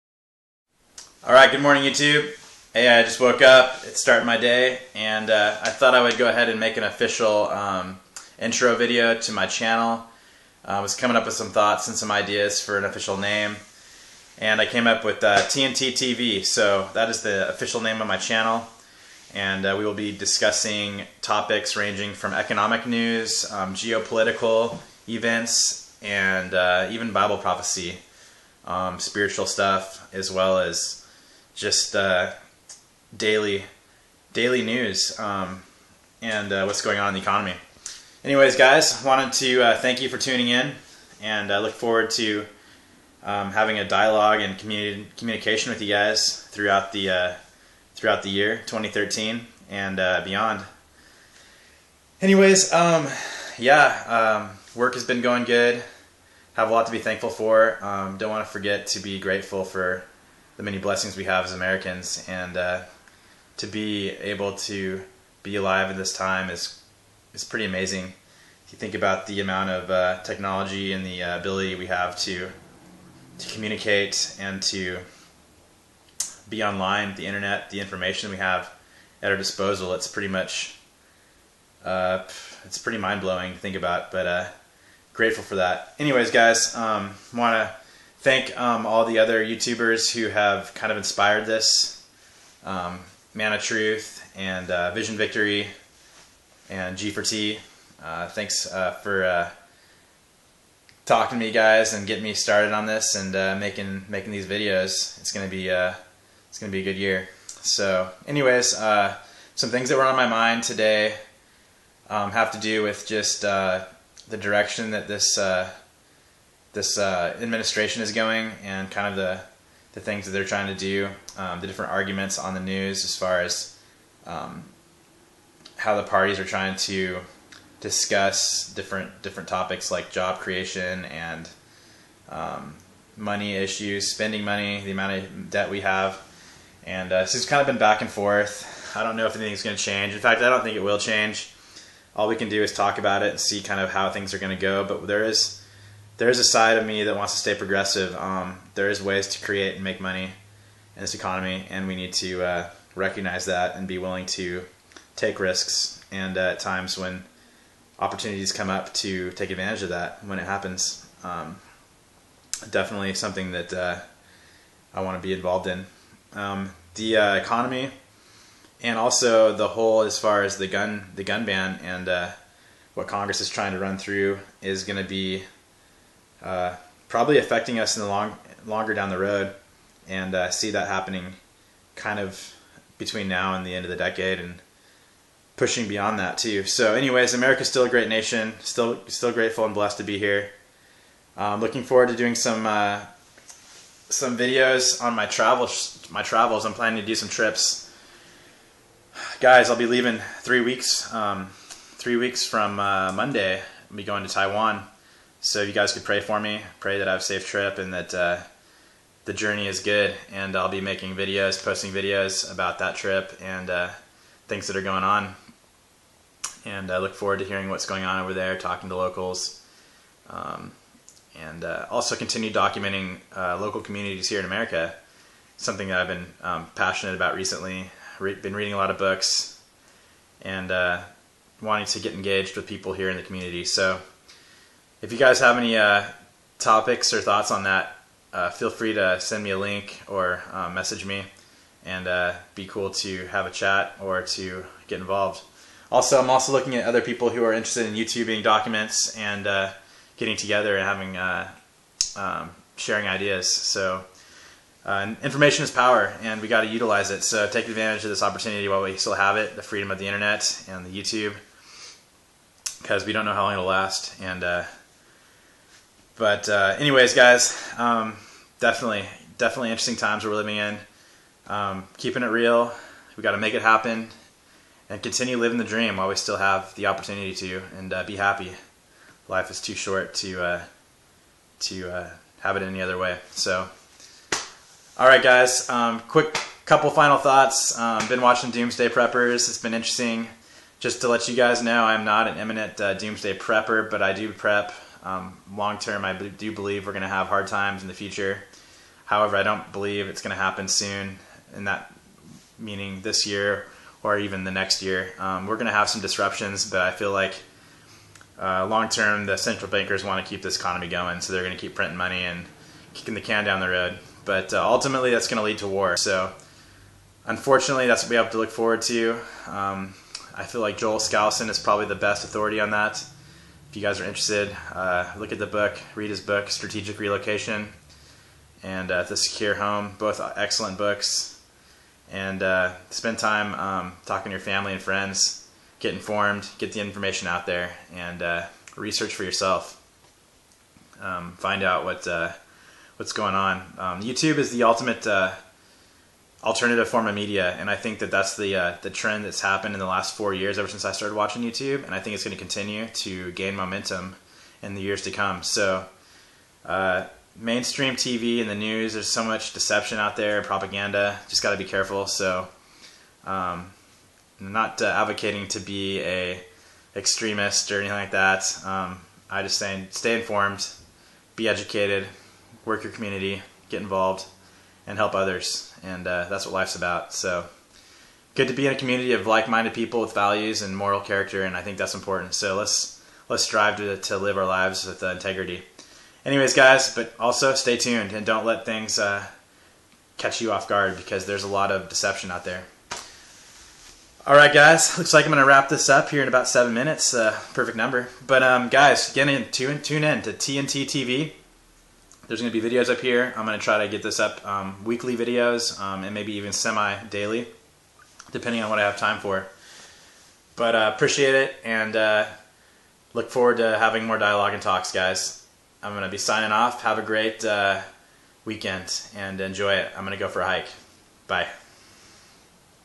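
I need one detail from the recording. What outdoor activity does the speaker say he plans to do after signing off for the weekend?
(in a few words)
a hike.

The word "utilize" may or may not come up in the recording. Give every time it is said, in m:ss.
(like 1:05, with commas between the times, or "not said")
4:16.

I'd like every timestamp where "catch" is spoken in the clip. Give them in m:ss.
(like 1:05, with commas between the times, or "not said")
6:30.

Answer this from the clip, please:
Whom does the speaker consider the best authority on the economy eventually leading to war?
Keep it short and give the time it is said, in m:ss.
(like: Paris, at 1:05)
Joel Skousen, at 5:20.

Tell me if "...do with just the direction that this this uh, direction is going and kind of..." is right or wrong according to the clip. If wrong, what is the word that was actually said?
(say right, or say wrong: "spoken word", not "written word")
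wrong: "administration", not "direction".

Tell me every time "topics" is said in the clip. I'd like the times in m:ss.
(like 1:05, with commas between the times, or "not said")
0:21, 2:09, 3:56.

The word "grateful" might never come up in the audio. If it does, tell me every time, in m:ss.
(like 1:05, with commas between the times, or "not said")
0:59, 1:25, 3:09.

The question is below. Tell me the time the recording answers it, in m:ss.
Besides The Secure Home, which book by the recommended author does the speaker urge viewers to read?
5:26.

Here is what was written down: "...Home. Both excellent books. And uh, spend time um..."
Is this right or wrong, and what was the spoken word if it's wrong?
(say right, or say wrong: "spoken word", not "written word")
right.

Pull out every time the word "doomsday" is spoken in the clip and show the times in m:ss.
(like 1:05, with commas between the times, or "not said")
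4:48, 4:52.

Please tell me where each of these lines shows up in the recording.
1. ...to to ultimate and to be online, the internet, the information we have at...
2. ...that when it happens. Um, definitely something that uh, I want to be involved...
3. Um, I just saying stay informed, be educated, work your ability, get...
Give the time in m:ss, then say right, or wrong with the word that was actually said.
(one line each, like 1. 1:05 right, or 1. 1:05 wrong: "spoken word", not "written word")
1. 1:12 wrong: "communicate", not "ultimate"
2. 2:39 right
3. 6:08 wrong: "community", not "ability".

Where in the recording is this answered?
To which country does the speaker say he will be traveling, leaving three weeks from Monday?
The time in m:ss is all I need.
3:24.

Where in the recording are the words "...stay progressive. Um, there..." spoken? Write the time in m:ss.
2:27.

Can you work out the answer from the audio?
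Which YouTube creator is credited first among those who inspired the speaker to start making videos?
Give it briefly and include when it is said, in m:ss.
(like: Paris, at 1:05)
Man of Truth, at 1:33.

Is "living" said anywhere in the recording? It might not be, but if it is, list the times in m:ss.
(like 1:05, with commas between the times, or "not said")
4:30, 4:35.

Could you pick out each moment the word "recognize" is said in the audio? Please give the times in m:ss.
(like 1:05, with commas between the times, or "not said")
2:32.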